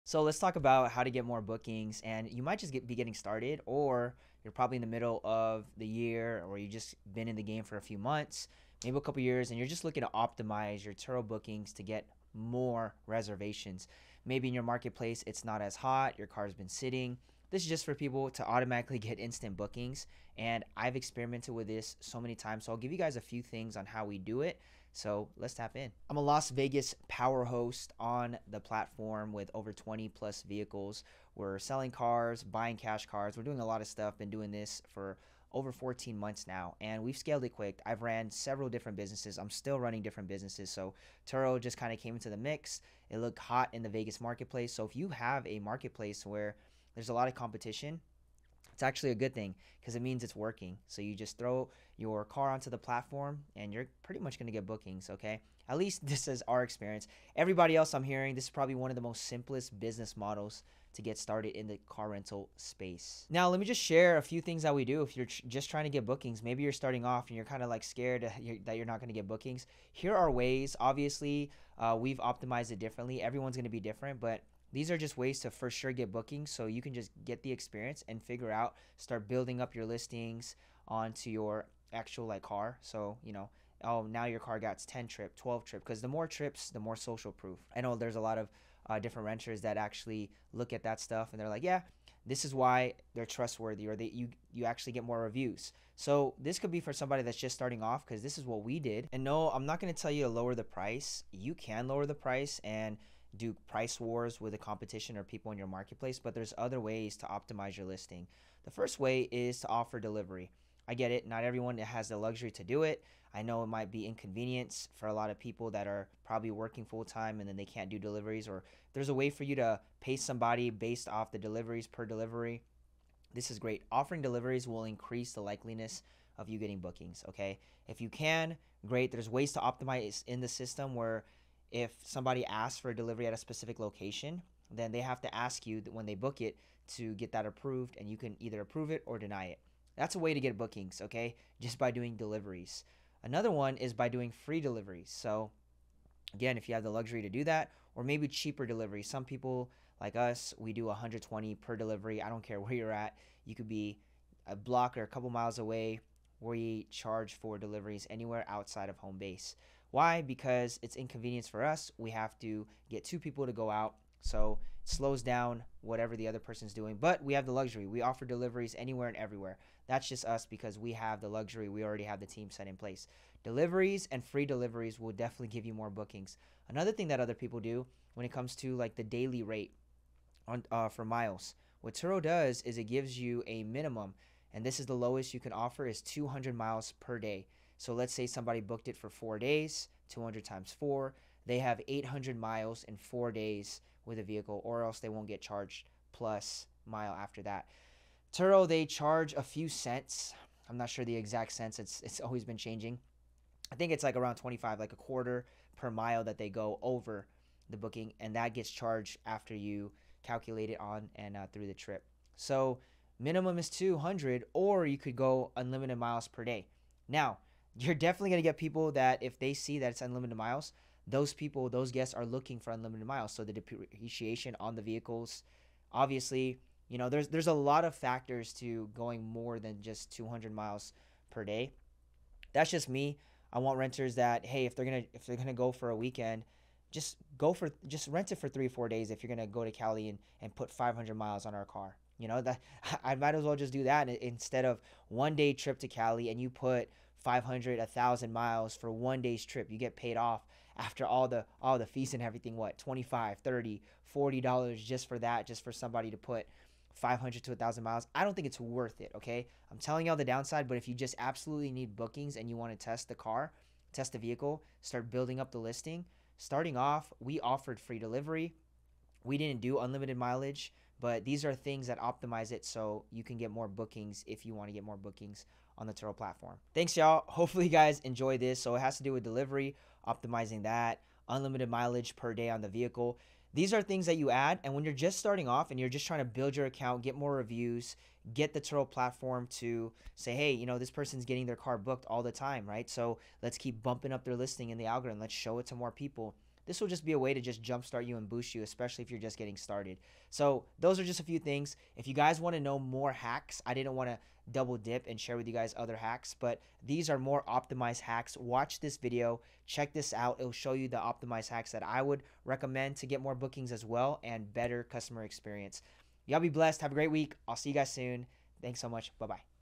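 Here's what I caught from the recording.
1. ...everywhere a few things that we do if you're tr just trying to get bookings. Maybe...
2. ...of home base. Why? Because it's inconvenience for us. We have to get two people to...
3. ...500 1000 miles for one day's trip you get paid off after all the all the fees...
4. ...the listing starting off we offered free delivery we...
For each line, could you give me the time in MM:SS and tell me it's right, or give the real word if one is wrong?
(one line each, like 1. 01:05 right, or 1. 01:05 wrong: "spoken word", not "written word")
1. 01:03 wrong: "share", not "everywhere"
2. 02:38 right
3. 04:07 right
4. 04:25 right.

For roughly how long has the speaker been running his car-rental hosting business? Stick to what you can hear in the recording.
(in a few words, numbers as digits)
14 months.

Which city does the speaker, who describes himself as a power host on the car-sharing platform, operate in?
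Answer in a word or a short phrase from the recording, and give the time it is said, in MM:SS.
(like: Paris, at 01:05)
Las Vegas, at 00:26.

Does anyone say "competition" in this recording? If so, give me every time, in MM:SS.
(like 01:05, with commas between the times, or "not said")
00:47, 01:44.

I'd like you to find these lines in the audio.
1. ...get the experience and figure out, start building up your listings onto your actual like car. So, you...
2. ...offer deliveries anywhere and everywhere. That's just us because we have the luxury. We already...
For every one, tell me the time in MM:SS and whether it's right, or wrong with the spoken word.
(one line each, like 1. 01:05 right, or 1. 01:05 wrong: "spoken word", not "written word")
1. 01:17 right
2. 02:48 right.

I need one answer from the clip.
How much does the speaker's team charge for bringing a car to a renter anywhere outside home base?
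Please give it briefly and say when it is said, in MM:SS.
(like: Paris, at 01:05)
$120, at 02:30.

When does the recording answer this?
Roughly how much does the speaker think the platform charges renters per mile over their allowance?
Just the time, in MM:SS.
03:24.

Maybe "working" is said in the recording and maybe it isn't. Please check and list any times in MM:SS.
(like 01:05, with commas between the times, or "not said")
00:50, 01:56.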